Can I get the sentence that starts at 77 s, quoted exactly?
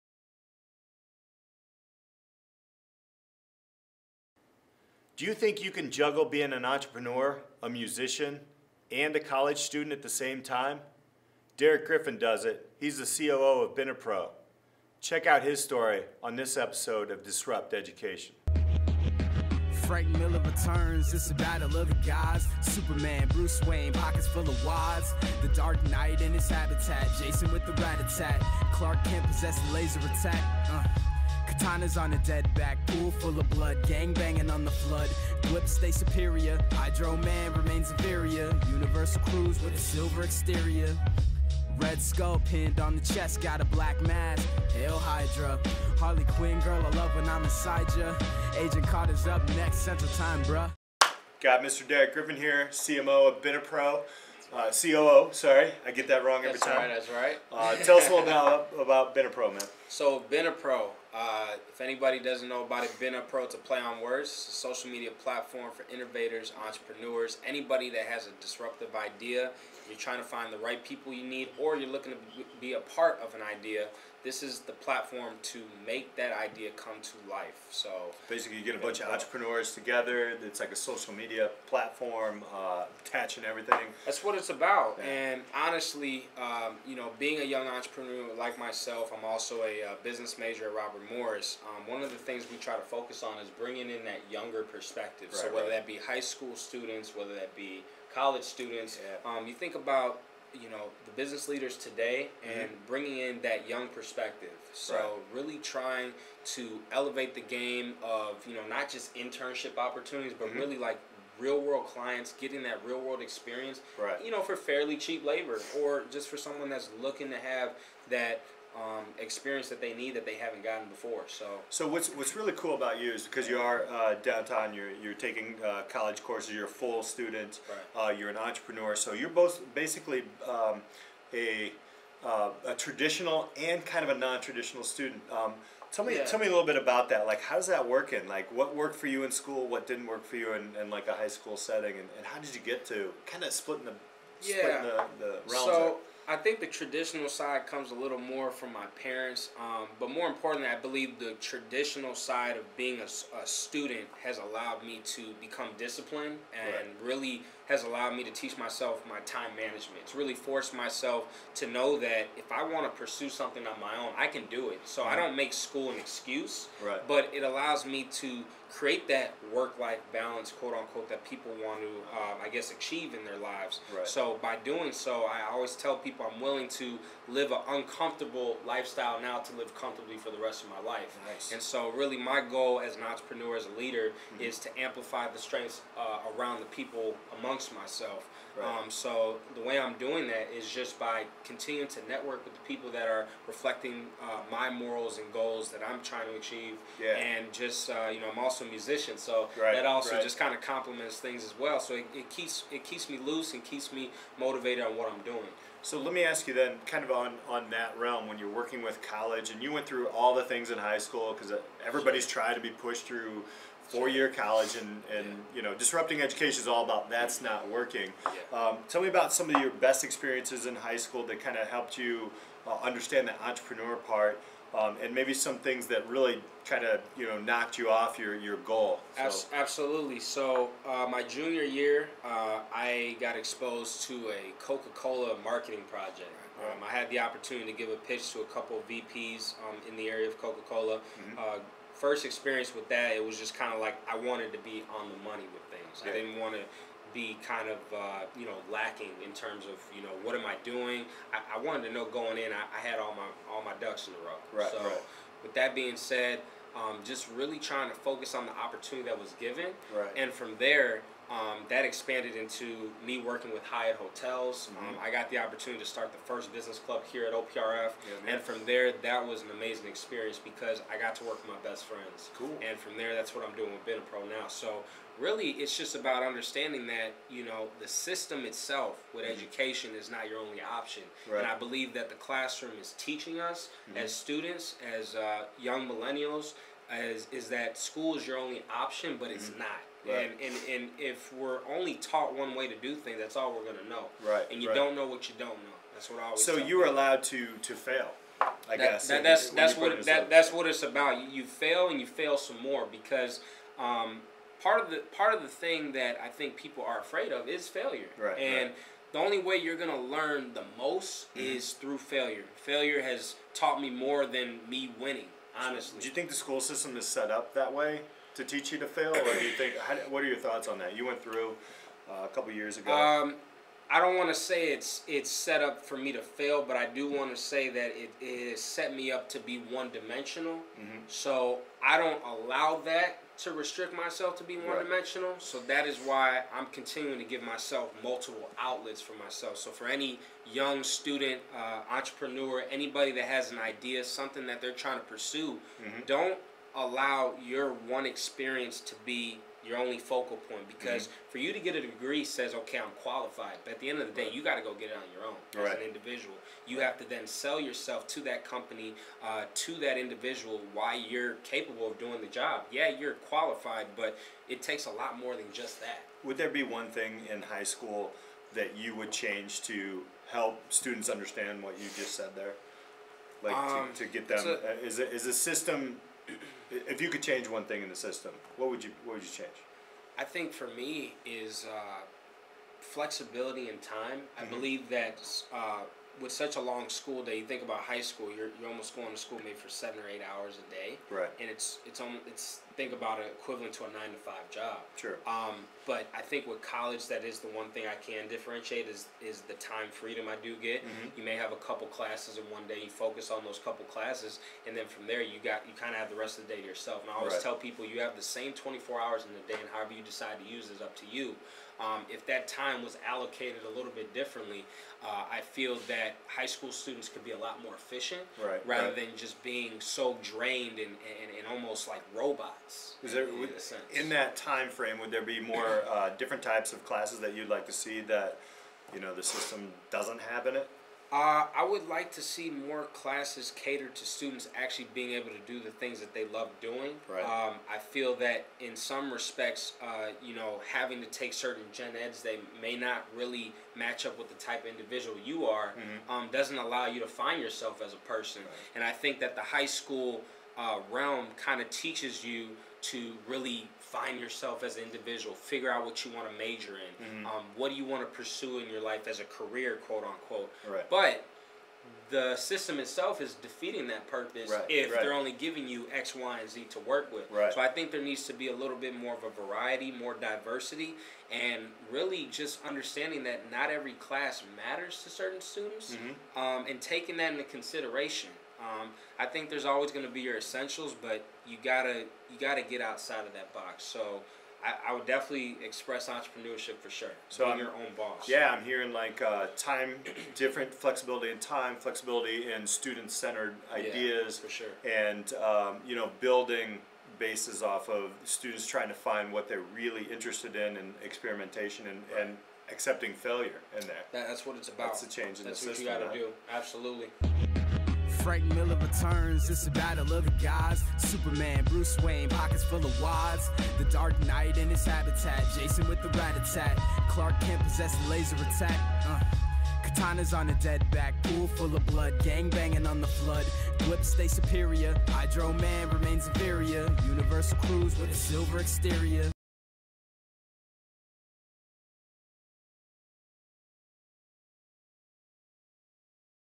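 So basically, you get a bunch of entrepreneurs together.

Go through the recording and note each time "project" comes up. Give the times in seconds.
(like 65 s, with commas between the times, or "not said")
235 s.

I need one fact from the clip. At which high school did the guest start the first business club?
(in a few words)
OPRF.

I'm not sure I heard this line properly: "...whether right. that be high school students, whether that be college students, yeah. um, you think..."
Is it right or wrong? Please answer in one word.
right.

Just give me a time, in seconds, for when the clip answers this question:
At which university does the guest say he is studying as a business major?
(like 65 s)
90 s.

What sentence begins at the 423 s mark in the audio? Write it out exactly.
Is there would, in that time frame?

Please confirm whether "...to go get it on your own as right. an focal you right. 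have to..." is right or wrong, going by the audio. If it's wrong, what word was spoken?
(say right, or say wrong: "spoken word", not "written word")
wrong: "individual", not "focal".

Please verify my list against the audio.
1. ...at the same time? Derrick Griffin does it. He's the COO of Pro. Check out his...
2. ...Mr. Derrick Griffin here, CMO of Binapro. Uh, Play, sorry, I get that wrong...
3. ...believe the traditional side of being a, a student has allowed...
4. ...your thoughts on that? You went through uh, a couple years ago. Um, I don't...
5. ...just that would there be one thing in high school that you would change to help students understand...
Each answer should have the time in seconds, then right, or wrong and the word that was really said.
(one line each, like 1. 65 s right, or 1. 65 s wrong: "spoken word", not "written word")
1. 9 s right
2. 51 s wrong: "COO", not "Play"
3. 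150 s right
4. 320 s right
5. 365 s right.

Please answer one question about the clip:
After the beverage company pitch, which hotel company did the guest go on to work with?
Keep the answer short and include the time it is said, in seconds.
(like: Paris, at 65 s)
Hyatt Hotels, at 263 s.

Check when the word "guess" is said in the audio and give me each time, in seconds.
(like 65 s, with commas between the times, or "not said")
172 s, 298 s.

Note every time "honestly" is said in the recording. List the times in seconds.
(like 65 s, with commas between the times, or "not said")
85 s, 315 s.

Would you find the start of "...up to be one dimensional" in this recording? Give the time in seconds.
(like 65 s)
329 s.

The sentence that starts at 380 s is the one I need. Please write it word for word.
I think for me is uh, flexibility and time.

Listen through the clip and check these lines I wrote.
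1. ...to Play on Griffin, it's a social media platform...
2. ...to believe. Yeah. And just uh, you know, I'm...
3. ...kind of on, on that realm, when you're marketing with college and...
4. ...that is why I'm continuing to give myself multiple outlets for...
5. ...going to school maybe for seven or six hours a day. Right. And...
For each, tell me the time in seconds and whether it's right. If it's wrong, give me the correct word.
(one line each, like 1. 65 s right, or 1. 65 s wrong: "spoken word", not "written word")
1. 63 s wrong: "Words", not "Griffin"
2. 196 s wrong: "achieve", not "believe"
3. 206 s wrong: "working", not "marketing"
4. 335 s right
5. 388 s wrong: "eight", not "six".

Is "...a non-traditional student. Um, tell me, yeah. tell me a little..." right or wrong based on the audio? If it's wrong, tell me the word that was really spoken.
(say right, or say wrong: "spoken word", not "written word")
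right.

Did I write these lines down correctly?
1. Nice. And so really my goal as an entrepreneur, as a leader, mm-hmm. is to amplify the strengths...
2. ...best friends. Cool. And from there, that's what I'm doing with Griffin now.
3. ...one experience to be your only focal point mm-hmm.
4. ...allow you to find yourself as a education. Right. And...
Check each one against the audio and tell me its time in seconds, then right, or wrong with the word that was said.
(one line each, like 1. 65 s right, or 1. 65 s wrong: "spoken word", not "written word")
1. 181 s right
2. 271 s wrong: "Benapro", not "Griffin"
3. 347 s right
4. 446 s wrong: "person", not "education".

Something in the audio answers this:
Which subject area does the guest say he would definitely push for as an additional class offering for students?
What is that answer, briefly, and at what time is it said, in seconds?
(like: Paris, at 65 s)
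entrepreneurship, at 486 s.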